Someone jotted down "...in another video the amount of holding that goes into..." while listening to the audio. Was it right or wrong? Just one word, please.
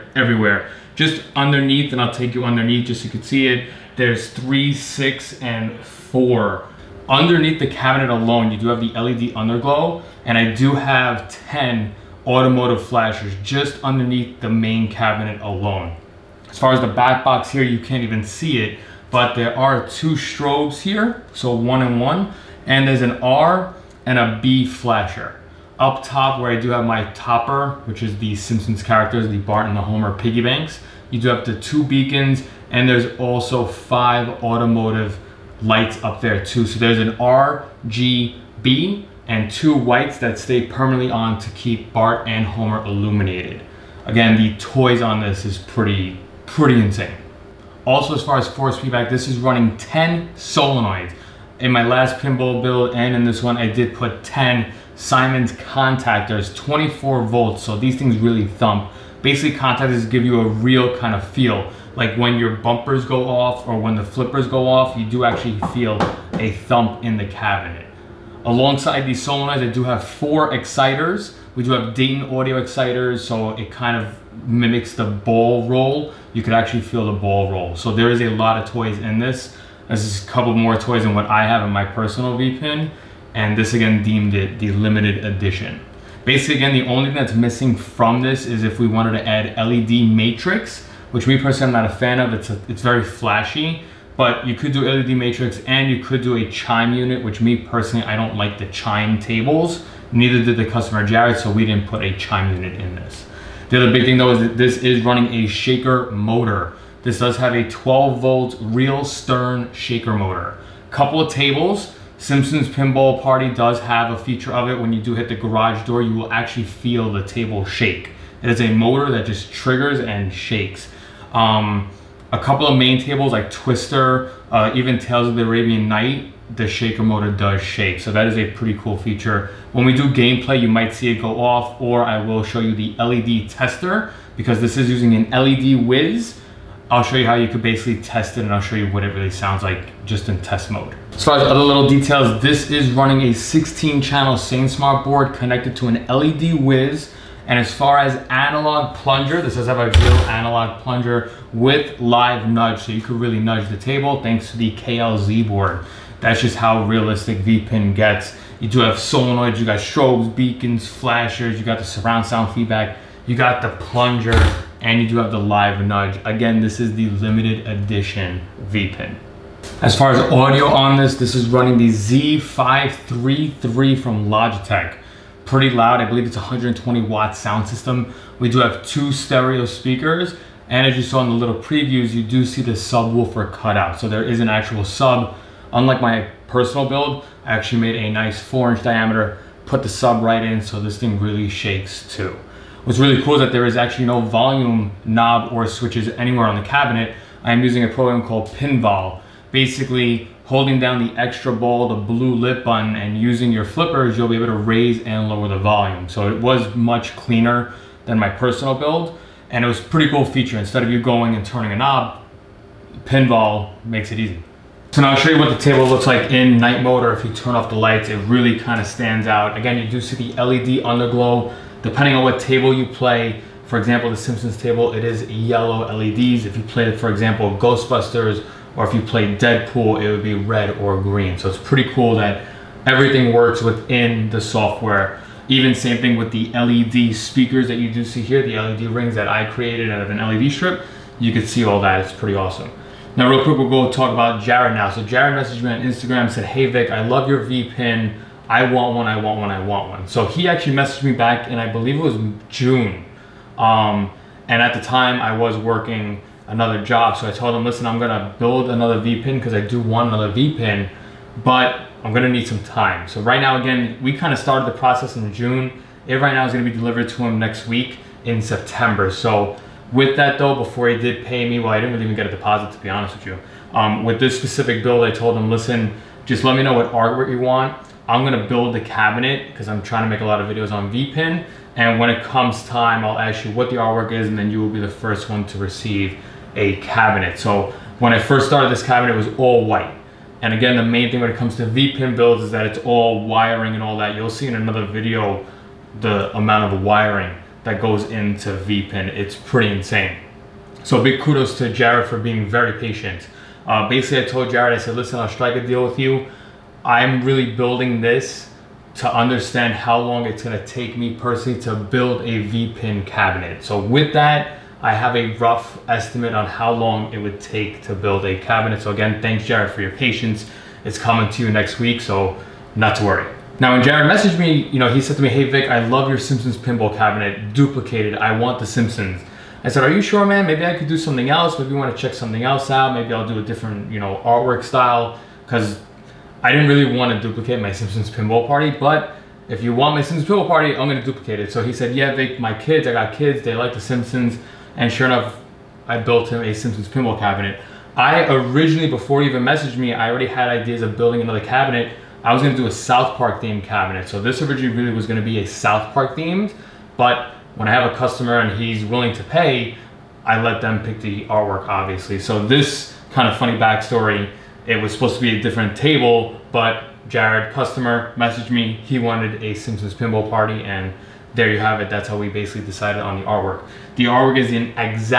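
wrong.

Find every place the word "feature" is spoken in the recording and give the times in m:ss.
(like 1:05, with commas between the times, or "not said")
1:54, 2:08, 3:30.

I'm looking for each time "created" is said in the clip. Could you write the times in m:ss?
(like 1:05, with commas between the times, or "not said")
3:59.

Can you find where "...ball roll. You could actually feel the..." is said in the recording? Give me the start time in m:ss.
1:15.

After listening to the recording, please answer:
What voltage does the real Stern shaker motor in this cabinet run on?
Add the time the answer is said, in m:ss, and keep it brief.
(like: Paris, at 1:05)
12 volt, at 1:47.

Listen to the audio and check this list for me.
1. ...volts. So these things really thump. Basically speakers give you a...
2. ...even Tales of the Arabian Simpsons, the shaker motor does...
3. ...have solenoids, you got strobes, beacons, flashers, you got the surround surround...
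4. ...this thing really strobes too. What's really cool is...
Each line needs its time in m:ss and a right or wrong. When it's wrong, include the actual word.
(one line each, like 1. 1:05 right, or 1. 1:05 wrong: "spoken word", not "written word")
1. 0:57 wrong: "contactors", not "speakers"
2. 2:04 wrong: "Night", not "Simpsons"
3. 2:38 wrong: "sound", not "surround"
4. 3:10 wrong: "shakes", not "strobes".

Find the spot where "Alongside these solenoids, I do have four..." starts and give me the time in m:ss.
1:08.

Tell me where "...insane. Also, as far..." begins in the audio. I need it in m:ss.
0:46.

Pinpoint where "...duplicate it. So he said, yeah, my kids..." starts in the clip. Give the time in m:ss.
5:41.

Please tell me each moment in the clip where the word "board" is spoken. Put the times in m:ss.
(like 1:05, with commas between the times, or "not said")
2:25, 2:35.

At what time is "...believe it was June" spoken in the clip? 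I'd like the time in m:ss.
4:11.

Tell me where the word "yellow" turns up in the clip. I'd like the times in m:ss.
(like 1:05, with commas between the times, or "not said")
3:45.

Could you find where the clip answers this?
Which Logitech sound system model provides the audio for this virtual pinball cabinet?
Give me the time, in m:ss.
2:51.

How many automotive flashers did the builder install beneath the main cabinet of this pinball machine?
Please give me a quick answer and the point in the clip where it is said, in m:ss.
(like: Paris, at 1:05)
10, at 0:11.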